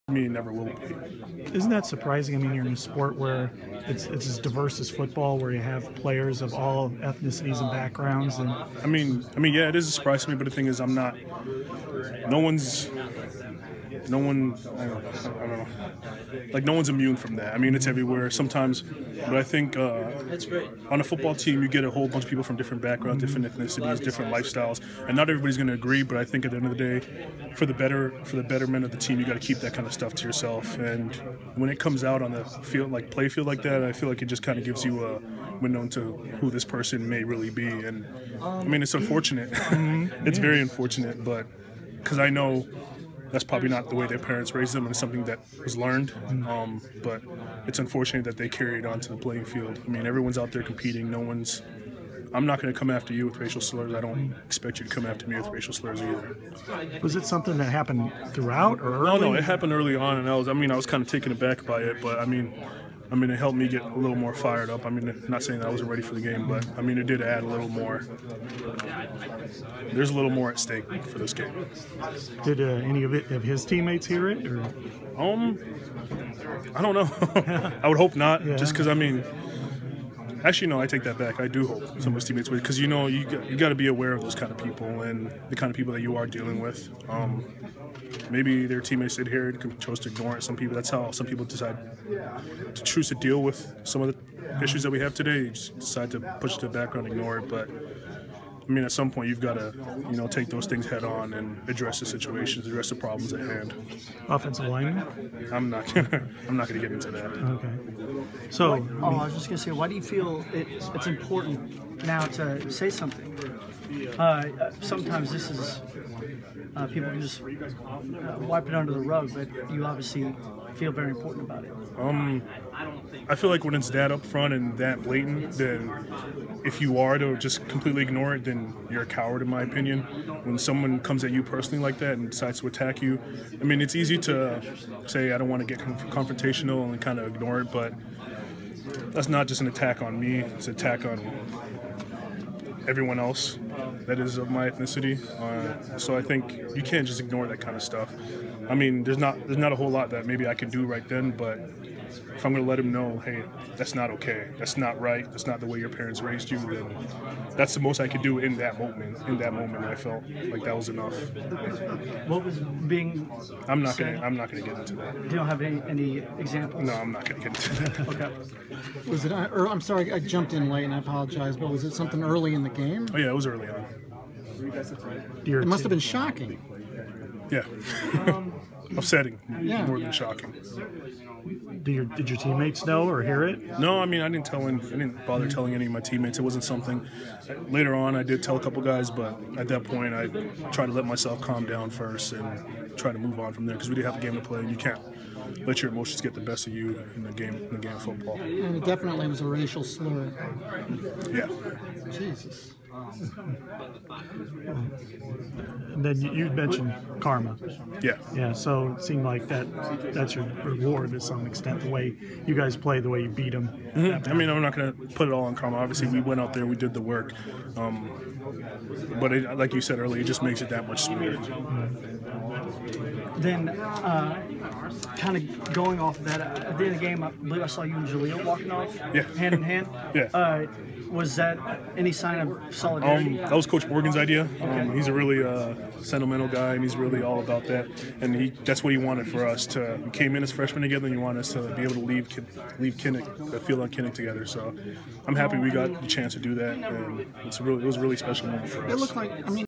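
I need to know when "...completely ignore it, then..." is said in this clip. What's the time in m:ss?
2:07.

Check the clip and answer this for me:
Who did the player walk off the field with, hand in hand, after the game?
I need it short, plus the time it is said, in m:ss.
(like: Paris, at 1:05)
Jaleel, at 3:48.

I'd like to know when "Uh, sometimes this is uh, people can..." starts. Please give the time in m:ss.
1:54.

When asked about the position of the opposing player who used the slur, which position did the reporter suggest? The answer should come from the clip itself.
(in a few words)
Offensive lineman.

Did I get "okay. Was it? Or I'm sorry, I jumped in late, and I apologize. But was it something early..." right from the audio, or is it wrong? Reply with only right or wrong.
right.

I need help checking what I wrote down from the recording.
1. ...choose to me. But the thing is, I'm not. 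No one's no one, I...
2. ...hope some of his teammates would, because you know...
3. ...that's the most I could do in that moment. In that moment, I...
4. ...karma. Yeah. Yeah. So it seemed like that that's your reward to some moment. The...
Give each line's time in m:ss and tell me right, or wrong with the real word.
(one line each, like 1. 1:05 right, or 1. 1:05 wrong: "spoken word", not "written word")
1. 0:09 wrong: "surprise", not "choose"
2. 1:21 right
3. 2:37 right
4. 3:27 wrong: "extent", not "moment".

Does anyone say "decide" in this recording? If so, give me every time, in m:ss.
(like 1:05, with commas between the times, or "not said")
1:31, 1:35, 2:12.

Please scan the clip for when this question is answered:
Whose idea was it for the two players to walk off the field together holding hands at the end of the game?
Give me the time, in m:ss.
3:53.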